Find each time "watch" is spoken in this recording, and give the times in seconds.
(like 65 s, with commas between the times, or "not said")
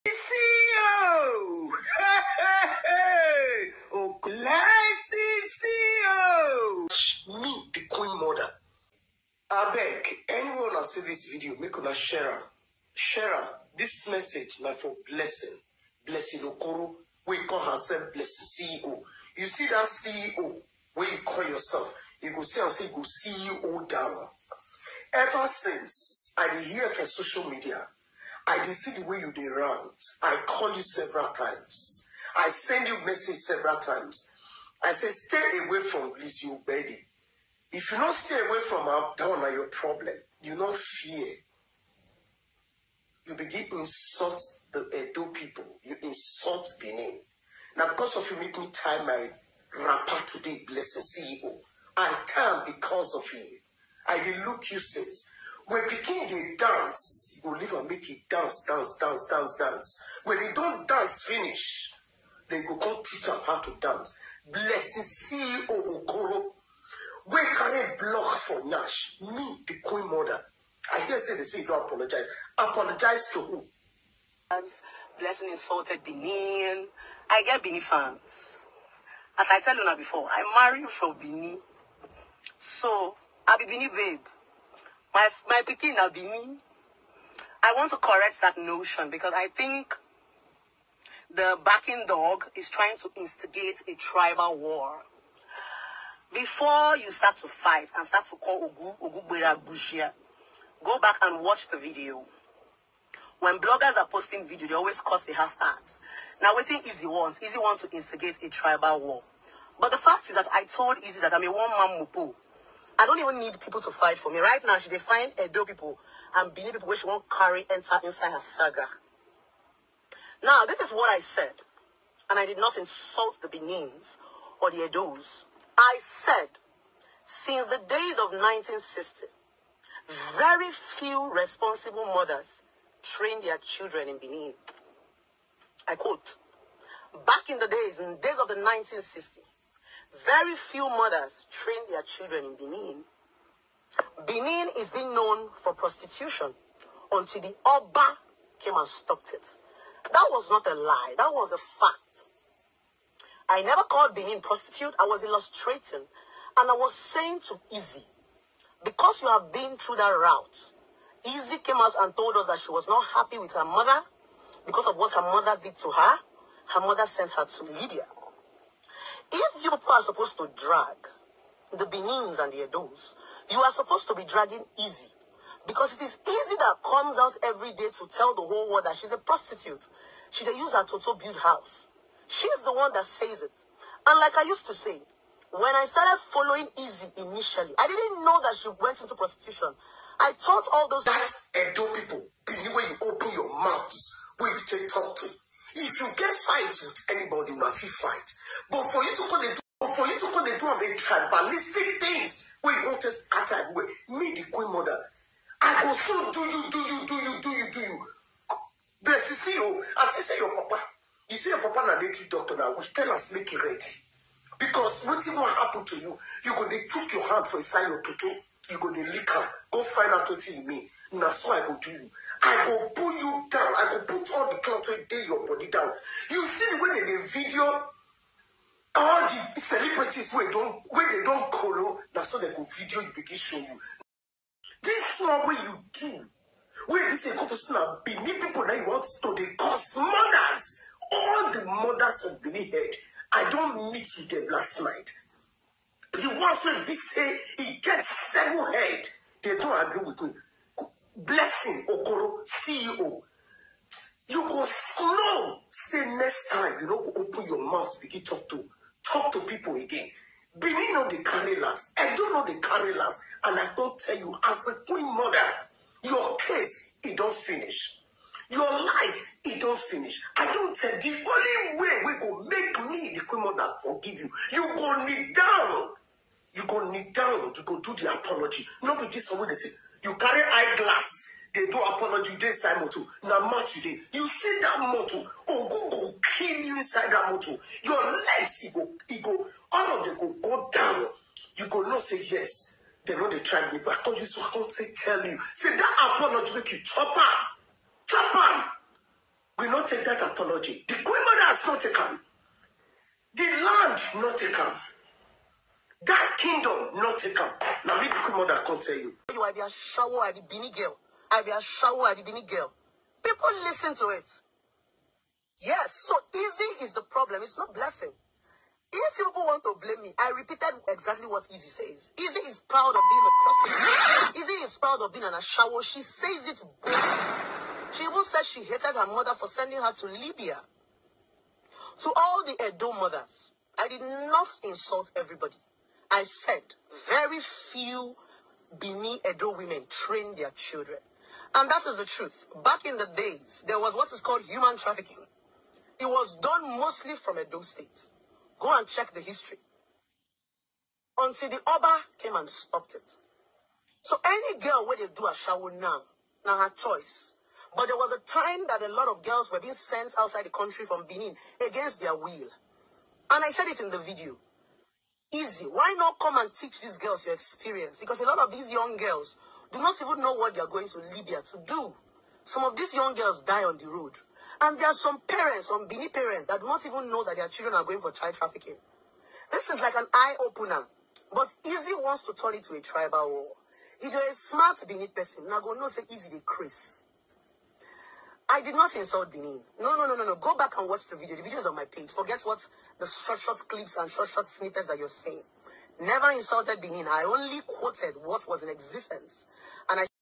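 101 s, 390 s.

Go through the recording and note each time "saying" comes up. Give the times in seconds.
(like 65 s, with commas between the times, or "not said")
156 s, 395 s.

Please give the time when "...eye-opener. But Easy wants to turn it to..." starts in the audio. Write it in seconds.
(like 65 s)
380 s.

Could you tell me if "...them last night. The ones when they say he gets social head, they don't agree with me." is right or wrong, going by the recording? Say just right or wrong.
wrong.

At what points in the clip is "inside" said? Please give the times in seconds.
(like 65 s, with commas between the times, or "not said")
118 s, 282 s, 286 s.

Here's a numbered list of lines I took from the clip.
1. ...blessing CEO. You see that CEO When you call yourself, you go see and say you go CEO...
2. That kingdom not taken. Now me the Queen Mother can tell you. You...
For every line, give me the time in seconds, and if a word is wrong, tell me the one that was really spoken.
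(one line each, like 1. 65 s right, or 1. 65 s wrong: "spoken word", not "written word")
1. 18 s right
2. 306 s right.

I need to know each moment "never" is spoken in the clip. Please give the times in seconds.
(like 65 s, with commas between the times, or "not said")
153 s, 396 s.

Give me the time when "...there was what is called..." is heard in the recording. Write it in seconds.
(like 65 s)
343 s.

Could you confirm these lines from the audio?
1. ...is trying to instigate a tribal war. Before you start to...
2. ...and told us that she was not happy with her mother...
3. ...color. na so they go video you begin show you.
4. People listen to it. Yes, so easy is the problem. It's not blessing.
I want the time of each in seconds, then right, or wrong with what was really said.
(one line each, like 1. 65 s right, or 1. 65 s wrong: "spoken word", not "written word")
1. 92 s right
2. 161 s right
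3. 231 s right
4. 313 s right.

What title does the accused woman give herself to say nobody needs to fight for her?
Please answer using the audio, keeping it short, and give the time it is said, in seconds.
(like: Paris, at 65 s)
one-man mupu, at 111 s.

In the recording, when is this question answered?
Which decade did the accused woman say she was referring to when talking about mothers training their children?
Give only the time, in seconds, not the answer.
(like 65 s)
128 s.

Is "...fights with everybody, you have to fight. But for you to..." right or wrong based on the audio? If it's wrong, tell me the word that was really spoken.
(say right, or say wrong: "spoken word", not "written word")
wrong: "anybody", not "everybody".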